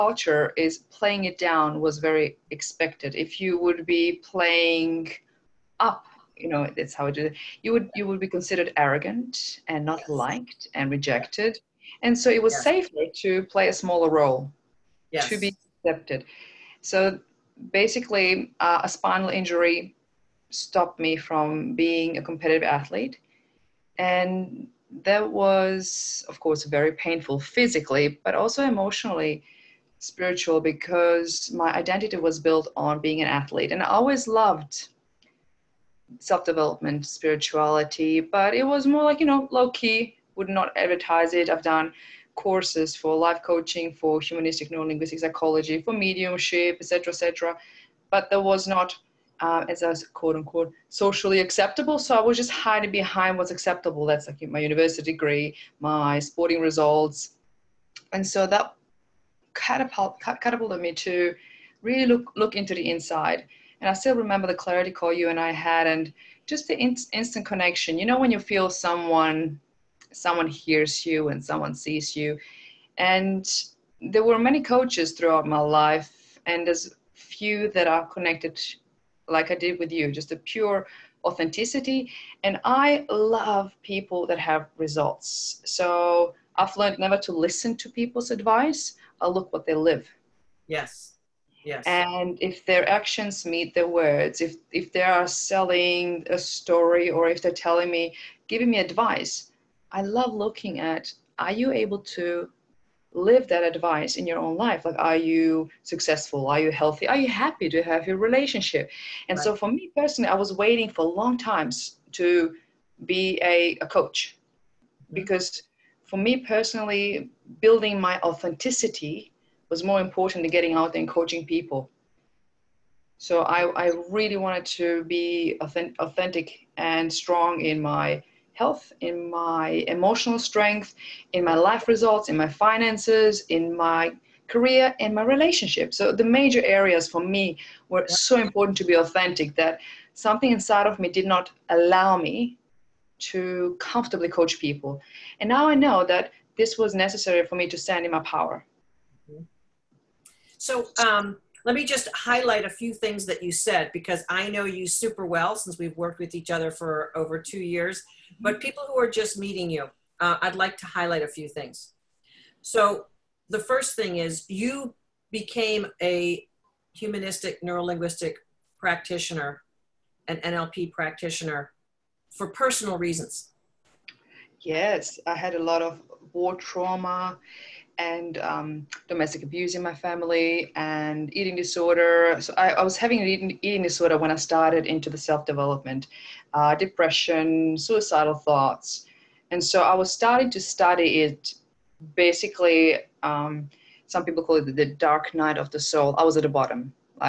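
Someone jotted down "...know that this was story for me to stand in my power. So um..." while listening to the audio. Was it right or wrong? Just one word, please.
wrong.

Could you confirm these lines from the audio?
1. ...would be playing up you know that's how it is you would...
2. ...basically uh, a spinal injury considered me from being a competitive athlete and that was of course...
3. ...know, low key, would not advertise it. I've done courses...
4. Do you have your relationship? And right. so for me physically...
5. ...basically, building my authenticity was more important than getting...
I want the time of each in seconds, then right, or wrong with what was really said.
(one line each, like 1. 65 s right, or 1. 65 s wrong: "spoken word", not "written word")
1. 3 s right
2. 17 s wrong: "stopped", not "considered"
3. 39 s right
4. 107 s wrong: "personally", not "physically"
5. 116 s wrong: "personally", not "basically".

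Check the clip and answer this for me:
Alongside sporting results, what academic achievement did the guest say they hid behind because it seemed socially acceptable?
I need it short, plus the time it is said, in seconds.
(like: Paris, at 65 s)
university degree, at 54 s.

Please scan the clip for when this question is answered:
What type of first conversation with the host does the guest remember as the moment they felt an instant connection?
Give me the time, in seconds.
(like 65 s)
64 s.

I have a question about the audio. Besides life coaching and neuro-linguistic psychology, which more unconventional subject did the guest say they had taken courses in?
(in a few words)
mediumship.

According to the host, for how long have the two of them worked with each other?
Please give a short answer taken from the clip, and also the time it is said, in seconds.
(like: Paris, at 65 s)
over 2 years, at 157 s.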